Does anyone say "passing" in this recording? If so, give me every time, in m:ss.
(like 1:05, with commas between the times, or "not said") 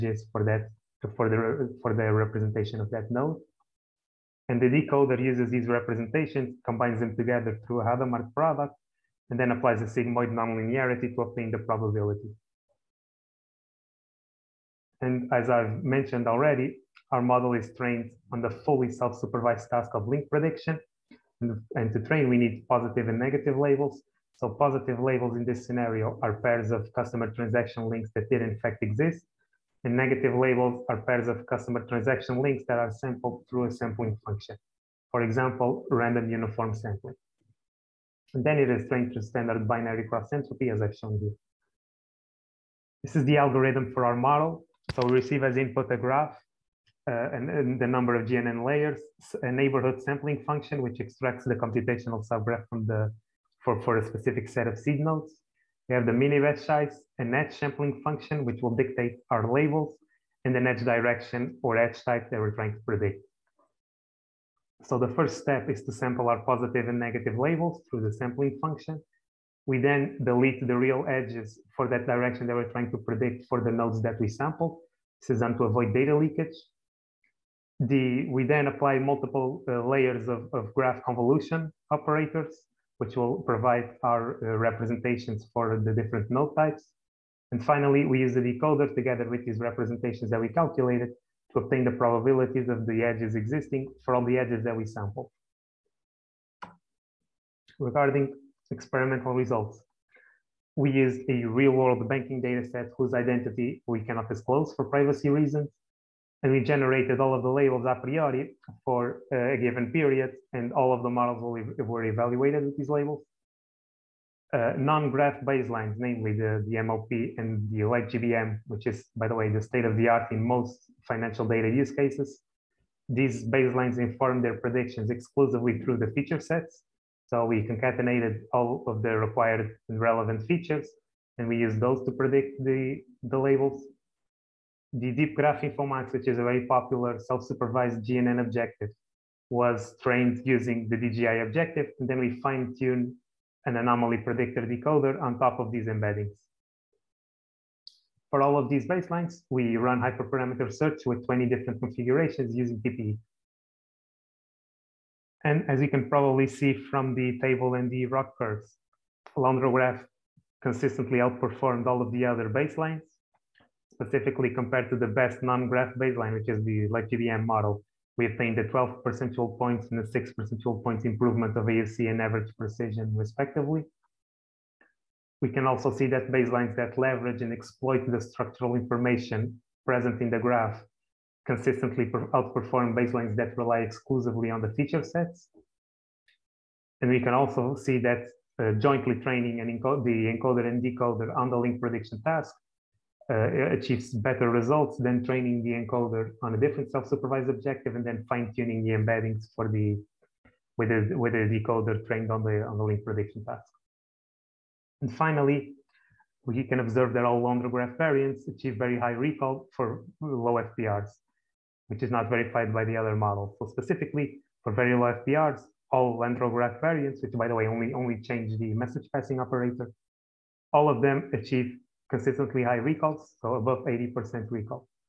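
3:39.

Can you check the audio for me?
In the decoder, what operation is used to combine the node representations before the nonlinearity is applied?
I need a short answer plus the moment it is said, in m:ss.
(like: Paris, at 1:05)
Hadamard product, at 0:07.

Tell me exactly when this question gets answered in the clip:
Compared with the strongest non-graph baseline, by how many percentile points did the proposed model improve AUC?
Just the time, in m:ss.
2:48.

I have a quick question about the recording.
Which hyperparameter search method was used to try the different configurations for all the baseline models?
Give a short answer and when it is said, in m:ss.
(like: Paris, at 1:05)
TPE, at 2:32.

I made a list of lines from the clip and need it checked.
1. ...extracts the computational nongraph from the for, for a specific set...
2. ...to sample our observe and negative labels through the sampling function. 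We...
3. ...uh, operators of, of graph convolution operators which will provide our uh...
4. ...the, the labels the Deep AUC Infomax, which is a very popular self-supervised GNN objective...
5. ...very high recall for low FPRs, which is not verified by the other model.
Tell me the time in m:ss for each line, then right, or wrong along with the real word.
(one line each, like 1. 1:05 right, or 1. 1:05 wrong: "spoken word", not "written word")
1. 0:50 wrong: "subgraph", not "nongraph"
2. 1:05 wrong: "positive", not "observe"
3. 1:19 wrong: "layers", not "operators"
4. 2:12 wrong: "Graph", not "AUC"
5. 3:28 right.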